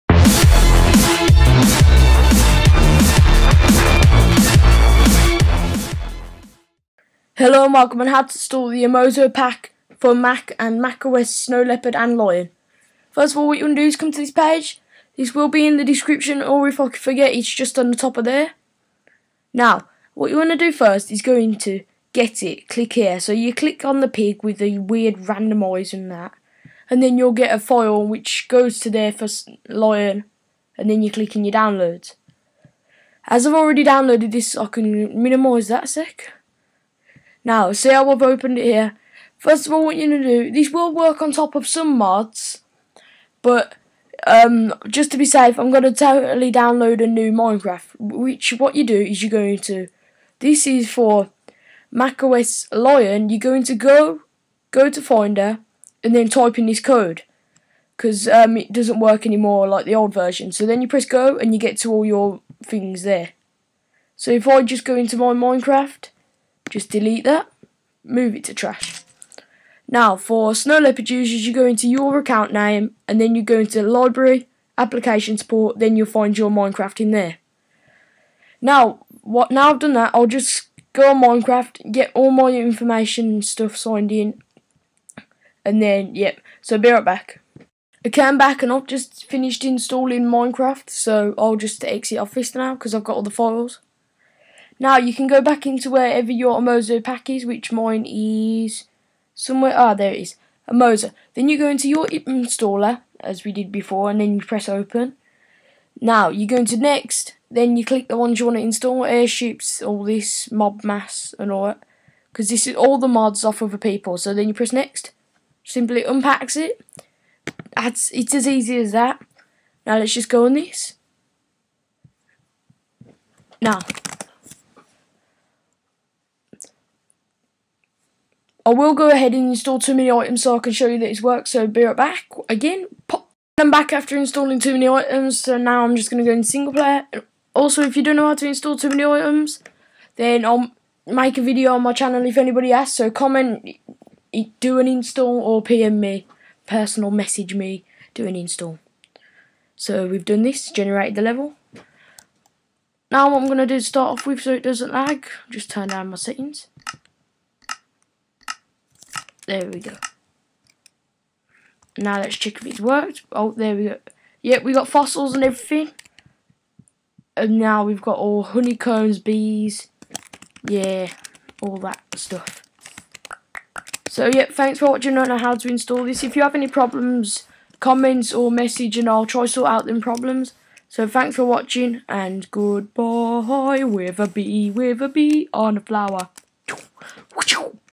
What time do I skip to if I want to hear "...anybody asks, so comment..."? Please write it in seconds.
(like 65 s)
142 s.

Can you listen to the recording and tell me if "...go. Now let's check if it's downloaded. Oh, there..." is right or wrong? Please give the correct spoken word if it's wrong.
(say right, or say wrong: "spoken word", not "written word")
wrong: "worked", not "downloaded".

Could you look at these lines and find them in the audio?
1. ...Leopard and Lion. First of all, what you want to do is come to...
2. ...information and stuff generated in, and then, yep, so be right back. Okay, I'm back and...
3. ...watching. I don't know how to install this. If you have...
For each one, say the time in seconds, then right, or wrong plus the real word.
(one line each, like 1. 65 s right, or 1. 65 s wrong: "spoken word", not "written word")
1. 11 s right
2. 82 s wrong: "signed", not "generated"
3. 174 s right.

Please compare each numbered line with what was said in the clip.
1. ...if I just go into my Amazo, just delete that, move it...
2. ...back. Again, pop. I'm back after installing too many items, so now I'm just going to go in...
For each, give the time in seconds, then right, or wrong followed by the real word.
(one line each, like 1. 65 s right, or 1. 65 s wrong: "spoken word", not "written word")
1. 64 s wrong: "Minecraft", not "Amazo"
2. 131 s right.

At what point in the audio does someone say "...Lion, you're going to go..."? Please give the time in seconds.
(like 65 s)
52 s.